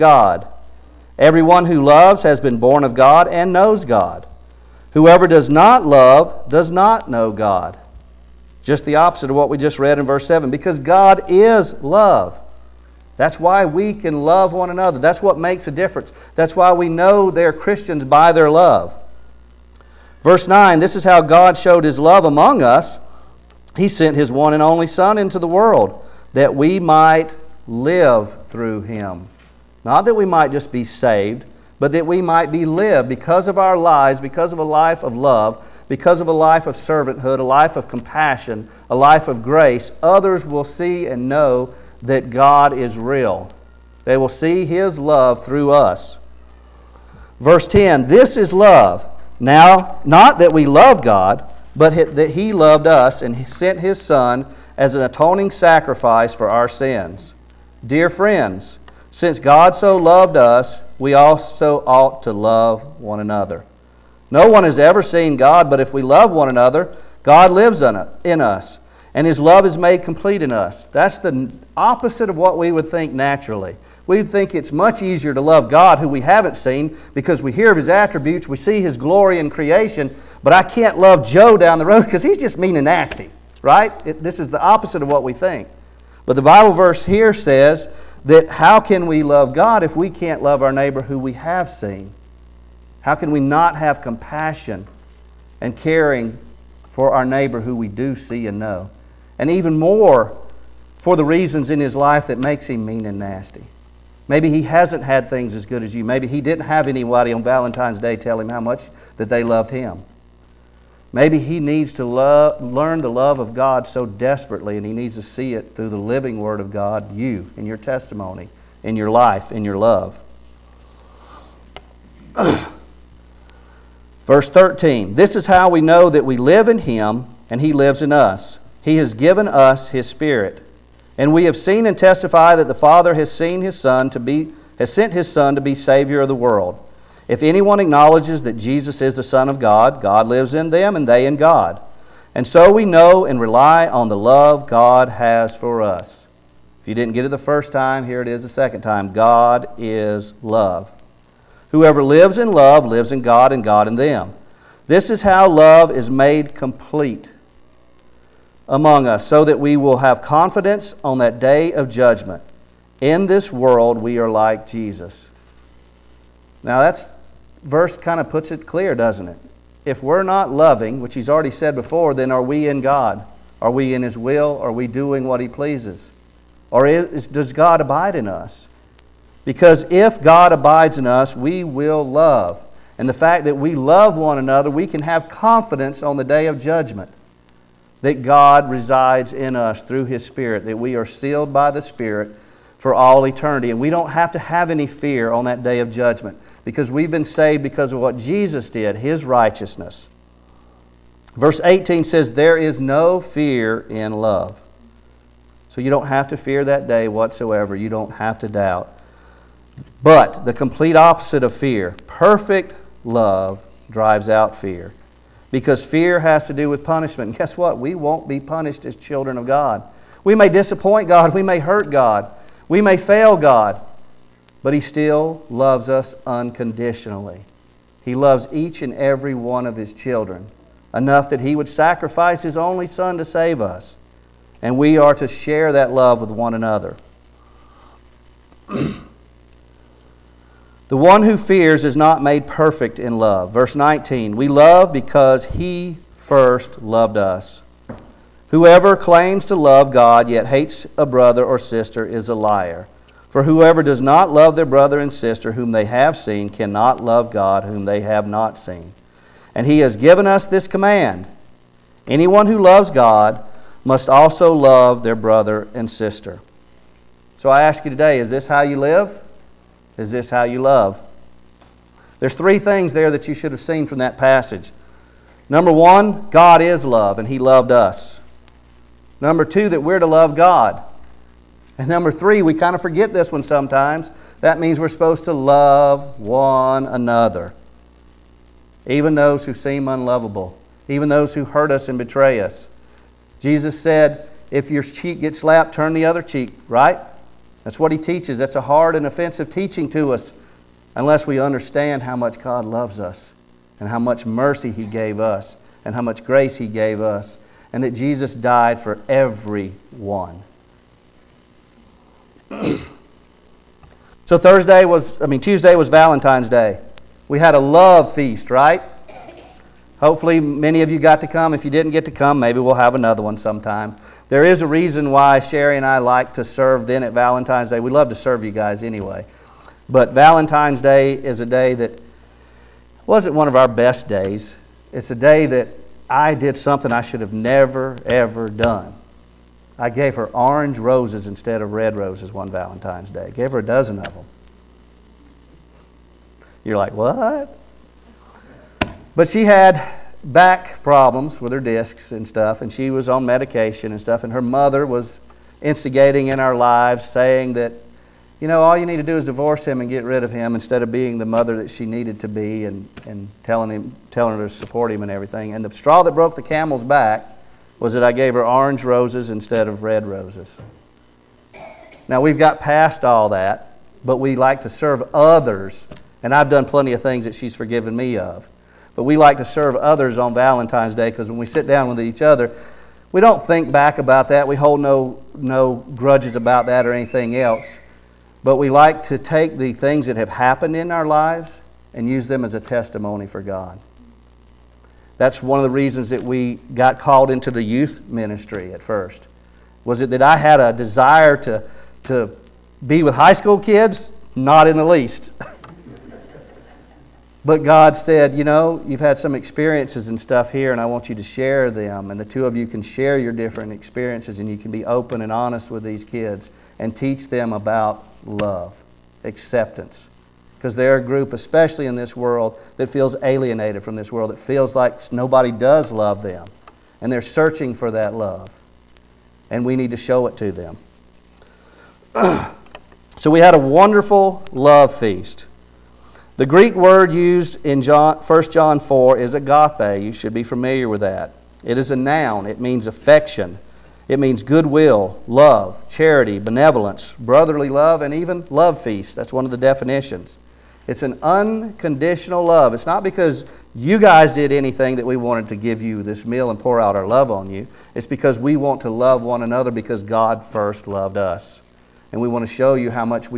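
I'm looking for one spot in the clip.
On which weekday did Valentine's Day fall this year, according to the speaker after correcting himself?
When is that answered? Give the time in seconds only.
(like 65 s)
315 s.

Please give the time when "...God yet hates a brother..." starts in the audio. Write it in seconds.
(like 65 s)
249 s.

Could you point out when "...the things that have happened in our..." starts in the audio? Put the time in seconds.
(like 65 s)
389 s.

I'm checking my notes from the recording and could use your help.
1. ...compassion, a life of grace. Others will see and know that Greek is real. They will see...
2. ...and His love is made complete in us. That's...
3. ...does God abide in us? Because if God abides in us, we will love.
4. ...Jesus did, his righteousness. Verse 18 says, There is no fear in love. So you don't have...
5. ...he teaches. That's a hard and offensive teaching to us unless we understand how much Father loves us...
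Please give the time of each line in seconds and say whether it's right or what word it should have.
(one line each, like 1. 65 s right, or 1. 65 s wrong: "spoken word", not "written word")
1. 37 s wrong: "God", not "Greek"
2. 69 s right
3. 177 s right
4. 198 s right
5. 297 s wrong: "God", not "Father".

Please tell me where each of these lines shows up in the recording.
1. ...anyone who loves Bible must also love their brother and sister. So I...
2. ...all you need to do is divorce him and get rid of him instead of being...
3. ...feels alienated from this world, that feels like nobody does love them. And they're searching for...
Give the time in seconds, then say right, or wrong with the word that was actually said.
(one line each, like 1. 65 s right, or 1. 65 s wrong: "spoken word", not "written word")
1. 262 s wrong: "God", not "Bible"
2. 358 s right
3. 422 s right.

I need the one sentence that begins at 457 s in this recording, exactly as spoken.
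It's because we want to love one another because God first loved us.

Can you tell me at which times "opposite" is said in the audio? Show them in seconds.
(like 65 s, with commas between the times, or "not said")
8 s, 71 s, 84 s, 210 s.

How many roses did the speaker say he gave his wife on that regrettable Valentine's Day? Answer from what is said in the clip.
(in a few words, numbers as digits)
A dozen.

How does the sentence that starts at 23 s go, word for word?
He sent his one and only Son into the world that we might live through him.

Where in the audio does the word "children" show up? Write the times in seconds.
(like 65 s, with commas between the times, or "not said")
218 s, 229 s.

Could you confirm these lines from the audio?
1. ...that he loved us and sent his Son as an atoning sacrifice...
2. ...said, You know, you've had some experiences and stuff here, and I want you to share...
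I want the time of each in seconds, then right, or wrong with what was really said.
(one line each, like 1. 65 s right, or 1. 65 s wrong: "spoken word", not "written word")
1. 52 s right
2. 407 s right.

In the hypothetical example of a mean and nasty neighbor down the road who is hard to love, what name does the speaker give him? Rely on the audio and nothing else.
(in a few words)
Joe.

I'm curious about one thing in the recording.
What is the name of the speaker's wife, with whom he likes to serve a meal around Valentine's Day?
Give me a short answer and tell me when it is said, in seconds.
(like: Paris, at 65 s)
Sherry, at 325 s.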